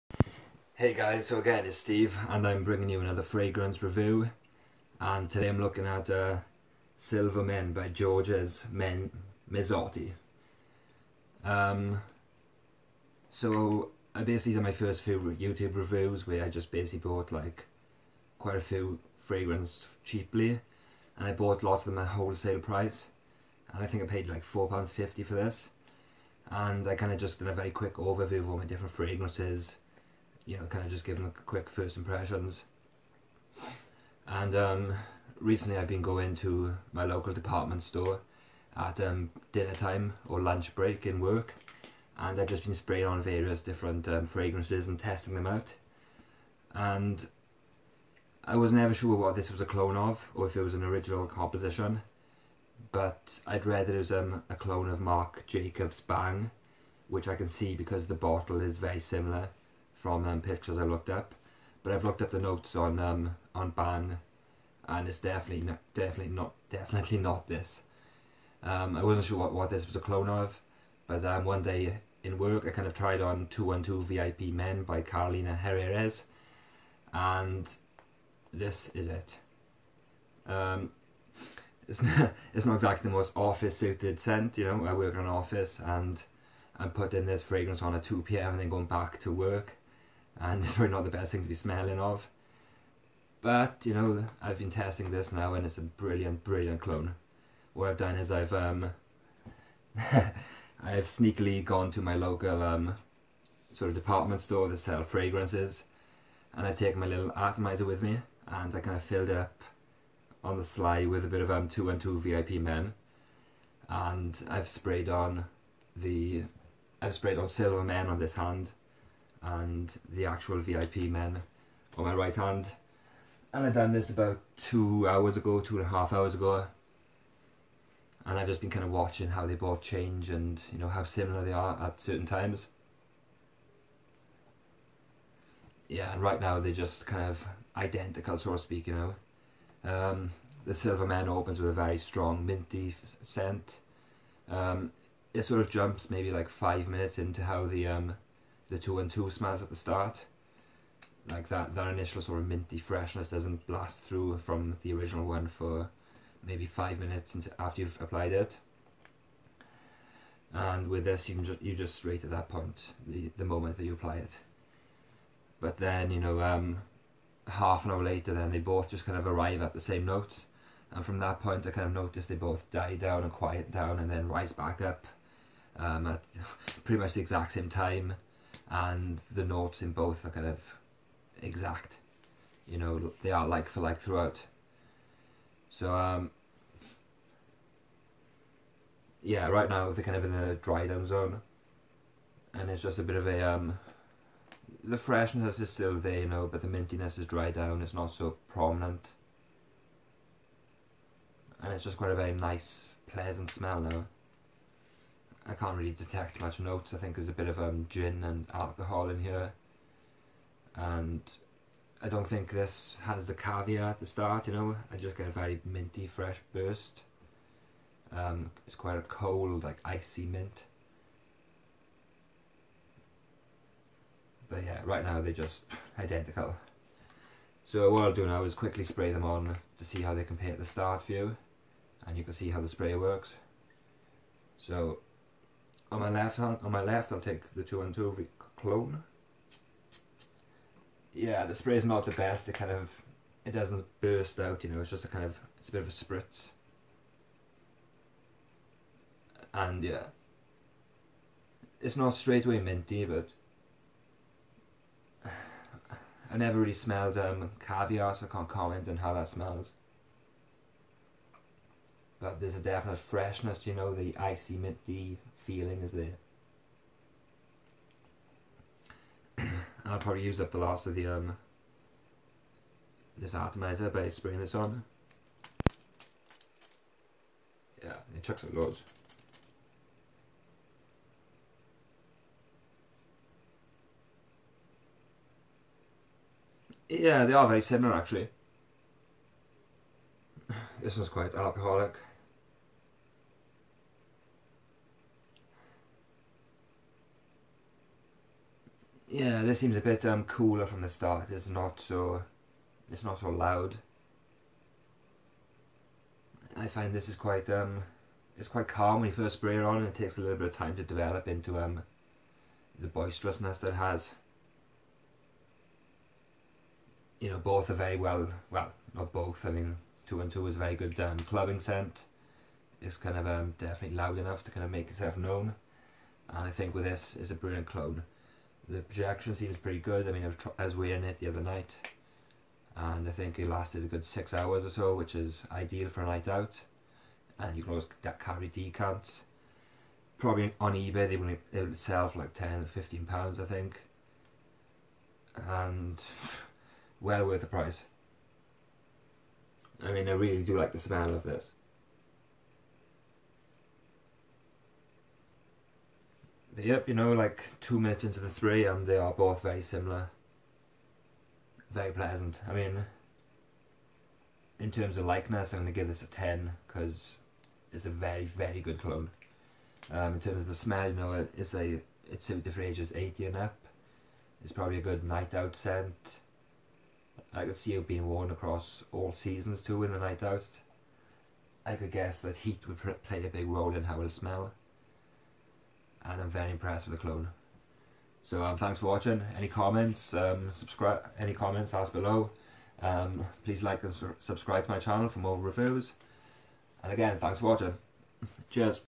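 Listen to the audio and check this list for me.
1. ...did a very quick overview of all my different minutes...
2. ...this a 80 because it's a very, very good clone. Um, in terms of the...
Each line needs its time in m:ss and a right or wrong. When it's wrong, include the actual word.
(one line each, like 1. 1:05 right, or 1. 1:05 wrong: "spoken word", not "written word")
1. 0:27 wrong: "fragrances", not "minutes"
2. 6:05 wrong: "10", not "80".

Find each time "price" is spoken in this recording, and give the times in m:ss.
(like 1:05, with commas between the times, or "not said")
0:22, 5:47.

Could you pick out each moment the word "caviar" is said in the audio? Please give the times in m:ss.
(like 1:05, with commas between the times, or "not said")
3:33, 4:17.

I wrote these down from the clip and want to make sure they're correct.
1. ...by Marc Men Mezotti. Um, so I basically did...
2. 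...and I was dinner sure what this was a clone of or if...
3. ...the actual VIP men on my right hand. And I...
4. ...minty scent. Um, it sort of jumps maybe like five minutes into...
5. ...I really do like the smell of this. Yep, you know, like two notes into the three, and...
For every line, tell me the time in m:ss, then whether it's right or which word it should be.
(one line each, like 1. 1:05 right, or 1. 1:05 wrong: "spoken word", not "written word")
1. 0:07 wrong: "Georges", not "Marc"
2. 0:46 wrong: "never", not "dinner"
3. 2:00 right
4. 2:22 right
5. 5:50 wrong: "minutes", not "notes".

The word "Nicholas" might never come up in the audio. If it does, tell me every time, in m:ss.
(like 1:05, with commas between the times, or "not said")
not said.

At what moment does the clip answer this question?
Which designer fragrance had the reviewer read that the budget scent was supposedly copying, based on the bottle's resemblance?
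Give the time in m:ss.
0:55.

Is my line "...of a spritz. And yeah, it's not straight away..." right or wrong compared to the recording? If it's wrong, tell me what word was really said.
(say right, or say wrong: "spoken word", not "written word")
right.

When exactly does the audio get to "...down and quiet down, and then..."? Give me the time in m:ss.
2:52.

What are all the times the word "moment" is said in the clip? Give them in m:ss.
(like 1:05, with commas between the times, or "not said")
2:43.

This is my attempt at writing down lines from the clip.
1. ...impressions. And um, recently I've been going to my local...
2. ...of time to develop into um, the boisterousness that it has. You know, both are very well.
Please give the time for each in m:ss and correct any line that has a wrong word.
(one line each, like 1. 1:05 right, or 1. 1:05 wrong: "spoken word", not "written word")
1. 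0:31 right
2. 5:10 right.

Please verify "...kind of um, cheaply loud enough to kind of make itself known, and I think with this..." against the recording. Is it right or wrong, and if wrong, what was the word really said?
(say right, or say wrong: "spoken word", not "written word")
wrong: "definitely", not "cheaply".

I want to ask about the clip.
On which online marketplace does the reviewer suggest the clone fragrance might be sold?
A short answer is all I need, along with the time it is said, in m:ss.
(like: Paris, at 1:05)
eBay, at 5:40.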